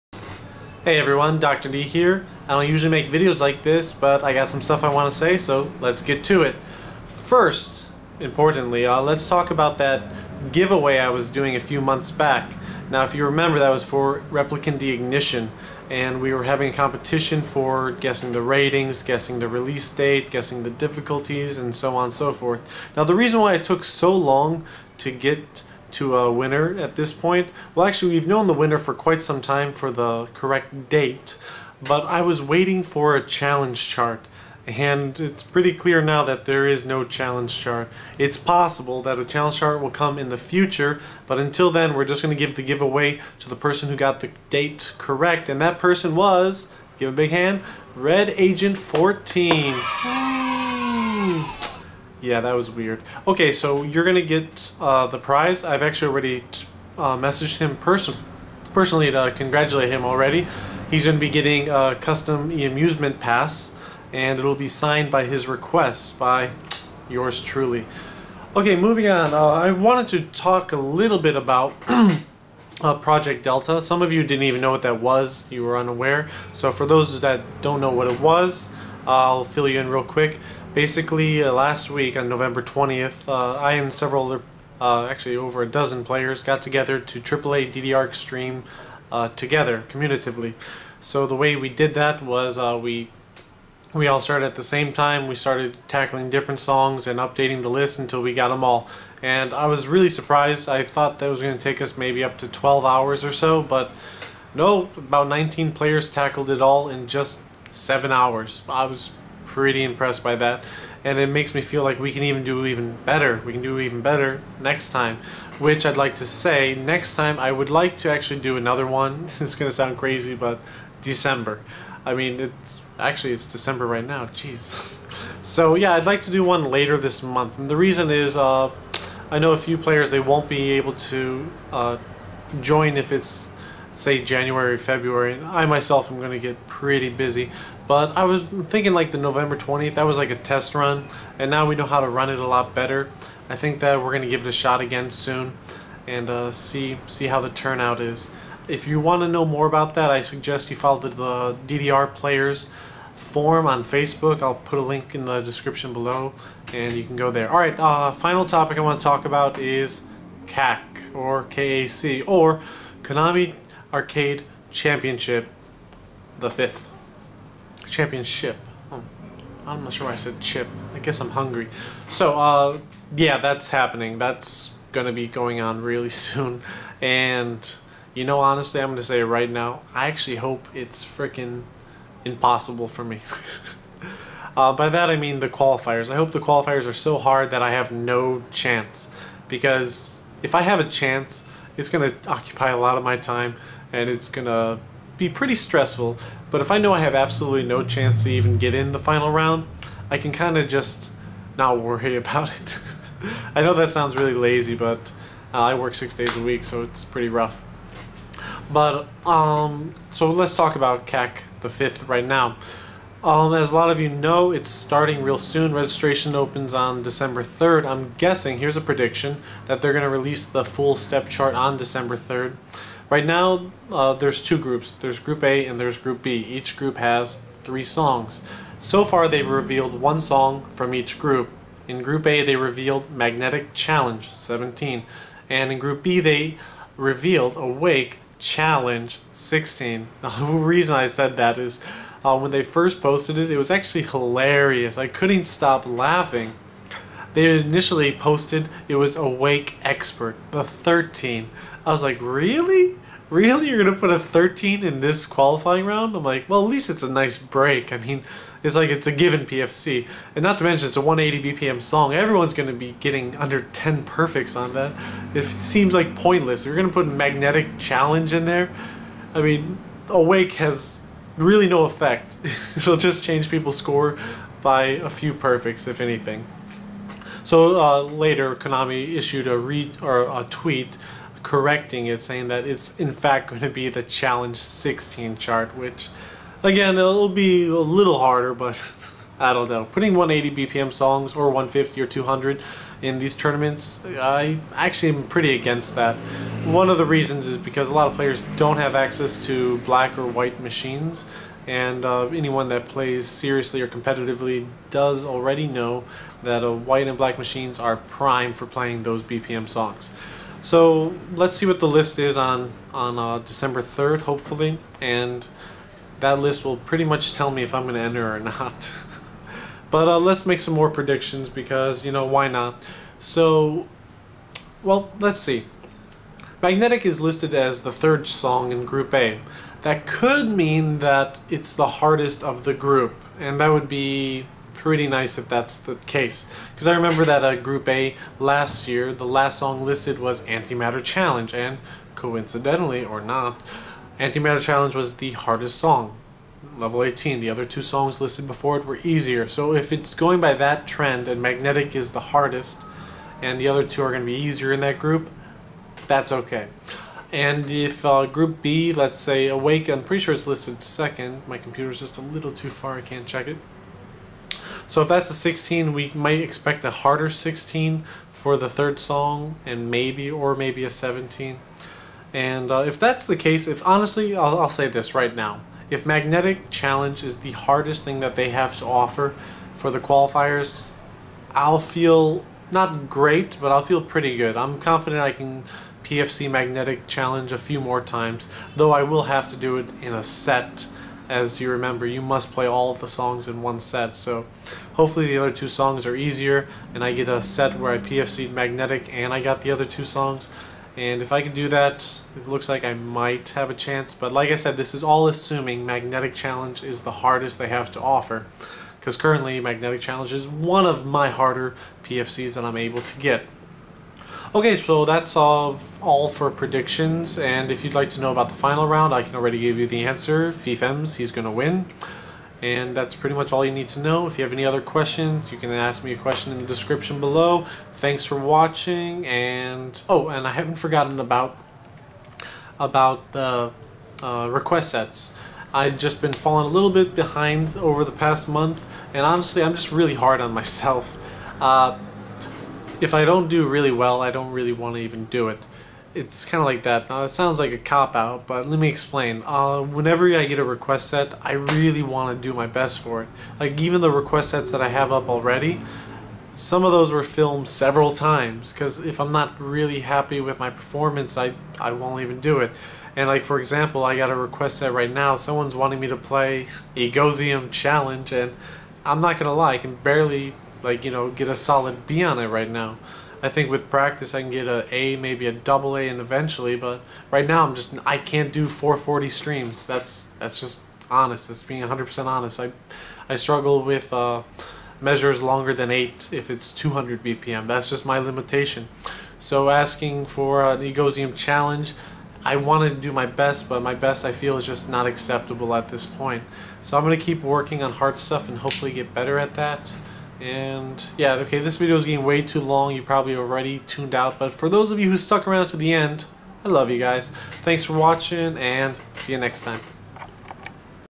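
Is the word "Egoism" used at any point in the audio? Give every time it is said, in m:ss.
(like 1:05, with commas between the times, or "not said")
7:46, 8:10.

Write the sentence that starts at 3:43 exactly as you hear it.
Right now, uh, there's two groups.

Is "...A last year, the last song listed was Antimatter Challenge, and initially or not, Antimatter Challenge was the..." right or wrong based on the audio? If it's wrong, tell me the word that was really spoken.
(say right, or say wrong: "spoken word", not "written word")
wrong: "coincidentally", not "initially".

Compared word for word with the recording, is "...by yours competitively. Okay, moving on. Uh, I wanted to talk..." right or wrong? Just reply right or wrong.
wrong.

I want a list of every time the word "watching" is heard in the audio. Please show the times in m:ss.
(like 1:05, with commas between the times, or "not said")
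7:08, 8:27.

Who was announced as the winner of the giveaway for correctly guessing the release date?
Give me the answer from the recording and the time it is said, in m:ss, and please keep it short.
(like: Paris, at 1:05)
RedAgent14, at 0:47.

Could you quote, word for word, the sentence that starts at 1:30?
So the way we did that was uh, we we all started at the same time.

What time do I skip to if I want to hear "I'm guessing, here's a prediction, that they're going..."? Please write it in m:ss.
3:37.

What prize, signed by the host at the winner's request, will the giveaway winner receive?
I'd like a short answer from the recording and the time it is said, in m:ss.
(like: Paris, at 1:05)
custom amusement pass, at 1:01.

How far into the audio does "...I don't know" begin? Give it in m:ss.
4:49.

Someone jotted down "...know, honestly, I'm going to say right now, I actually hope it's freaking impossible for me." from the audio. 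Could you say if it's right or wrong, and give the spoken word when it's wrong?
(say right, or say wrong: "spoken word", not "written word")
right.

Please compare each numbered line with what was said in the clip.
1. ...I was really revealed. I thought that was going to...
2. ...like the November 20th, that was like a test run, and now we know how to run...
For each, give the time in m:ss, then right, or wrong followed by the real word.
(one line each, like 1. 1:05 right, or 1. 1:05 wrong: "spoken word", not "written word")
1. 1:39 wrong: "surprised", not "revealed"
2. 2:18 right.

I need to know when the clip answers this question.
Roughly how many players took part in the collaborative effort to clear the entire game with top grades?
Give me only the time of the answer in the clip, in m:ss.
1:45.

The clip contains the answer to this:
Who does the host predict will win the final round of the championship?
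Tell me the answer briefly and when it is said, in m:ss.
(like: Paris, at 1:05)
FEFEMZ, at 7:00.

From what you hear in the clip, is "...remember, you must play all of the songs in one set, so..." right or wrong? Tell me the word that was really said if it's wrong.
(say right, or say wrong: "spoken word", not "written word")
right.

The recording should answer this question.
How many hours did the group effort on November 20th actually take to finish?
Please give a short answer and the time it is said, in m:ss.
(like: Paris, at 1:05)
7, at 1:47.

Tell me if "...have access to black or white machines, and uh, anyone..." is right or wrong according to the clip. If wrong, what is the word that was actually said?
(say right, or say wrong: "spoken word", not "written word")
right.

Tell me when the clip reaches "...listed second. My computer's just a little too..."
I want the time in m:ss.
6:00.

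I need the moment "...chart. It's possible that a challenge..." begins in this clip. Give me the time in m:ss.
0:37.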